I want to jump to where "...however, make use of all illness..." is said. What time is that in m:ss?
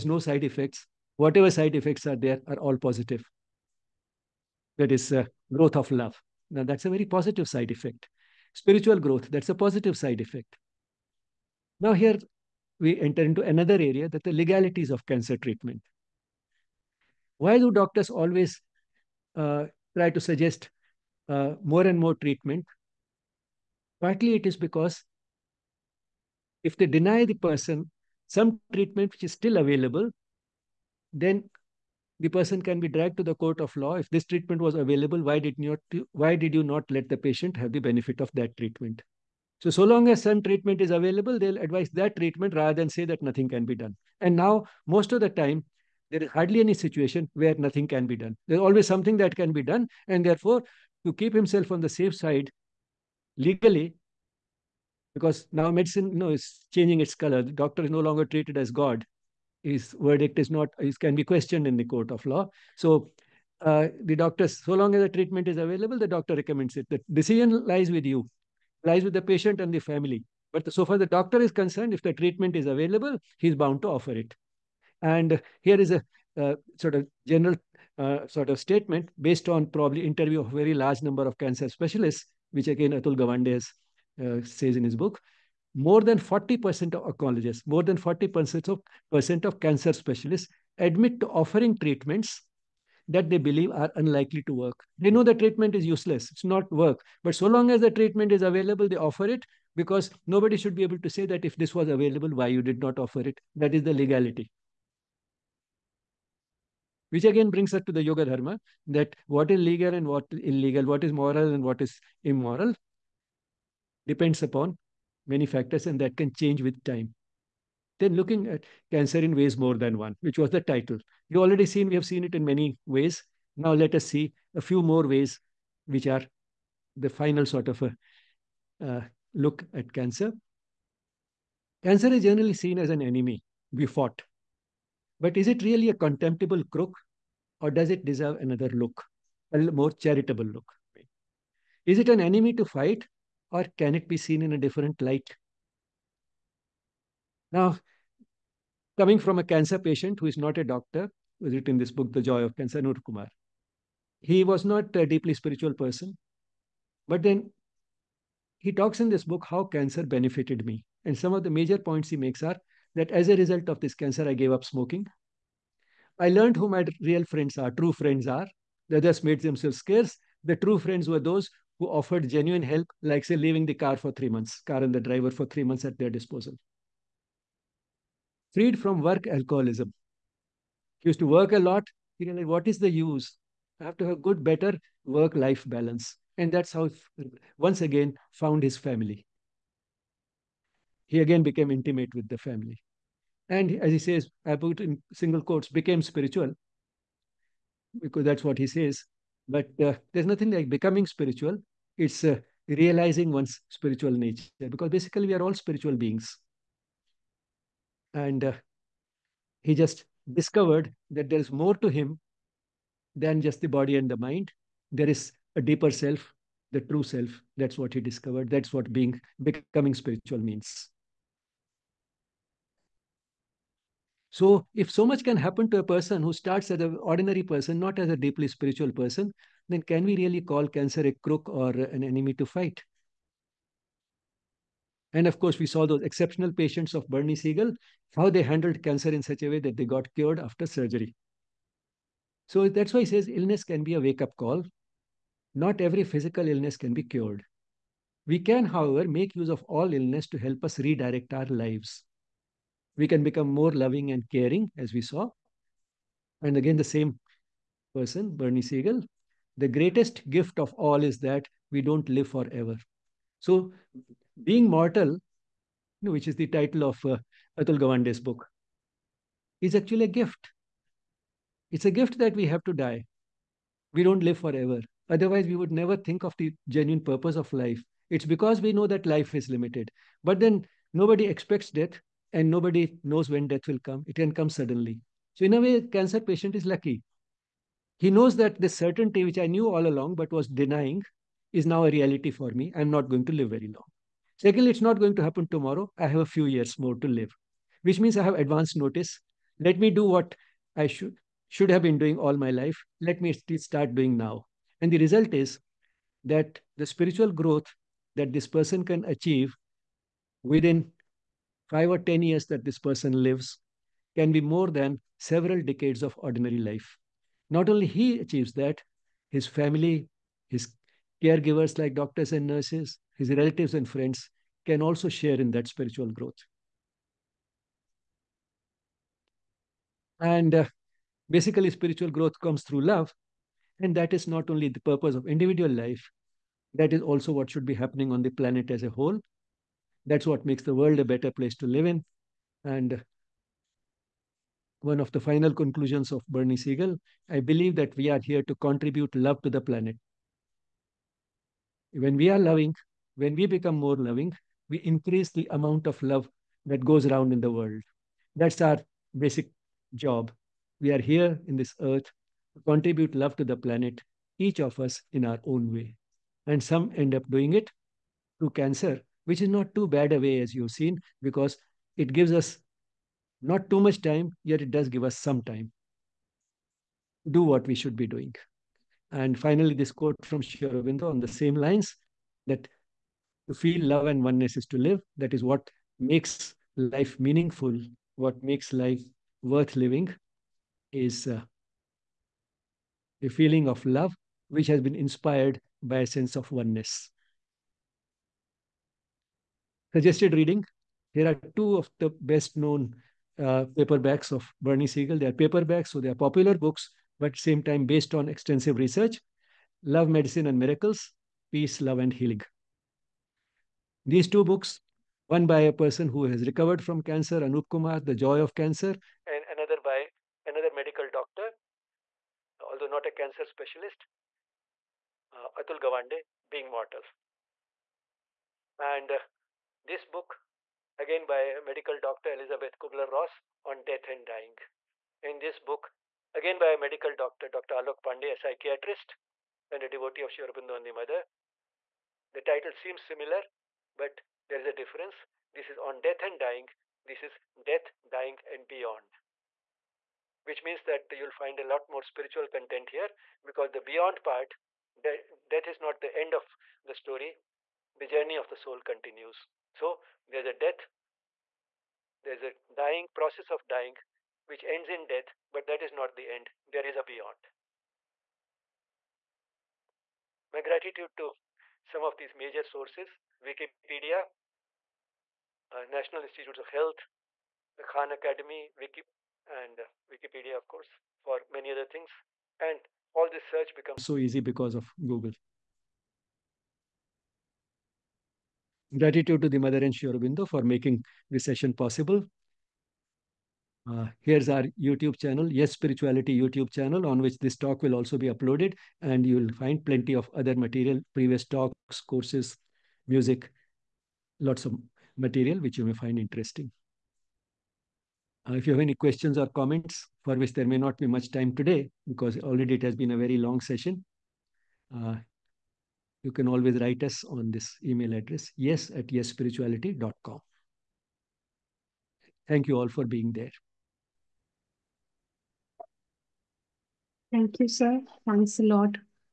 4:08.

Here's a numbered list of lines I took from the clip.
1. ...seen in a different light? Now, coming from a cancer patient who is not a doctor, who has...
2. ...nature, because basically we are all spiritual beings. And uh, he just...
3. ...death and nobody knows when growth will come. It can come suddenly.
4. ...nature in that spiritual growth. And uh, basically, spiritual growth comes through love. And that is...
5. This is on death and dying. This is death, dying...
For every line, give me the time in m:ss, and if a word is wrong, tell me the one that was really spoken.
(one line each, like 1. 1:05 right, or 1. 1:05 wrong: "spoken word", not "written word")
1. 2:24 right
2. 3:24 right
3. 4:41 wrong: "death", not "growth"
4. 5:25 wrong: "share", not "nature"
5. 7:25 right.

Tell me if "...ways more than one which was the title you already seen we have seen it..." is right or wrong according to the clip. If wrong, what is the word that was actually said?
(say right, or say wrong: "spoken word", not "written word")
right.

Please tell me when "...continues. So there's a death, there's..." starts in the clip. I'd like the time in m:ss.
7:38.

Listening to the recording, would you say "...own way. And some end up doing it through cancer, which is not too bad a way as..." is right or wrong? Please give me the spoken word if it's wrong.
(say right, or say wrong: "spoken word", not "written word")
right.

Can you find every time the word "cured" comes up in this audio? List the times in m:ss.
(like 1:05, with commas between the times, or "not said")
4:00, 4:07.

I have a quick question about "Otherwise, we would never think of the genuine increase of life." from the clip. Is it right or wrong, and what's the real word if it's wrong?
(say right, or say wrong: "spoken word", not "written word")
wrong: "purpose", not "increase".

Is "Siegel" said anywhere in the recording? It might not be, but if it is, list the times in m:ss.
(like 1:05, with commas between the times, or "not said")
3:57, 4:18, 5:46, 6:44.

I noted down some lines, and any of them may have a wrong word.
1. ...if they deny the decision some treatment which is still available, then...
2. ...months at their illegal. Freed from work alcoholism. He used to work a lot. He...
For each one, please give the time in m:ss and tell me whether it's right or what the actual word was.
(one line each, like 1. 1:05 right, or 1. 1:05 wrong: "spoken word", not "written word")
1. 0:26 wrong: "person", not "decision"
2. 2:55 wrong: "disposal", not "illegal".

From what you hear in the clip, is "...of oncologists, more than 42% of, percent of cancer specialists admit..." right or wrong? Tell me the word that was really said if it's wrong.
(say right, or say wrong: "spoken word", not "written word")
wrong: "40", not "42".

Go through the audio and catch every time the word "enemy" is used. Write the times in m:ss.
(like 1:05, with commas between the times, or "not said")
2:13, 2:22, 3:52.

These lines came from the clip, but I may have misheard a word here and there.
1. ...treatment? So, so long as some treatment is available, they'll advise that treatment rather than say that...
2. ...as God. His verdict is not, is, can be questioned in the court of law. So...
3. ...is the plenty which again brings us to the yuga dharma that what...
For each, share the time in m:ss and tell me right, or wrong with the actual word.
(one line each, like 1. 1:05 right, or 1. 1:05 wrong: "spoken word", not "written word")
1. 0:38 right
2. 0:58 right
3. 1:43 wrong: "legality", not "plenty".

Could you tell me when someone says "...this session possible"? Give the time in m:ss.
8:11.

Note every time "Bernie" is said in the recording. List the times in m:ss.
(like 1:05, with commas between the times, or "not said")
3:57, 4:18, 5:46, 6:44.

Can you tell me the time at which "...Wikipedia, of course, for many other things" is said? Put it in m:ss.
8:00.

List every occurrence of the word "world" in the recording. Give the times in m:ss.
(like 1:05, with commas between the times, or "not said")
5:40, 5:57.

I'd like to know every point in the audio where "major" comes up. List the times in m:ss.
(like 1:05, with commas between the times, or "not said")
2:41, 7:52.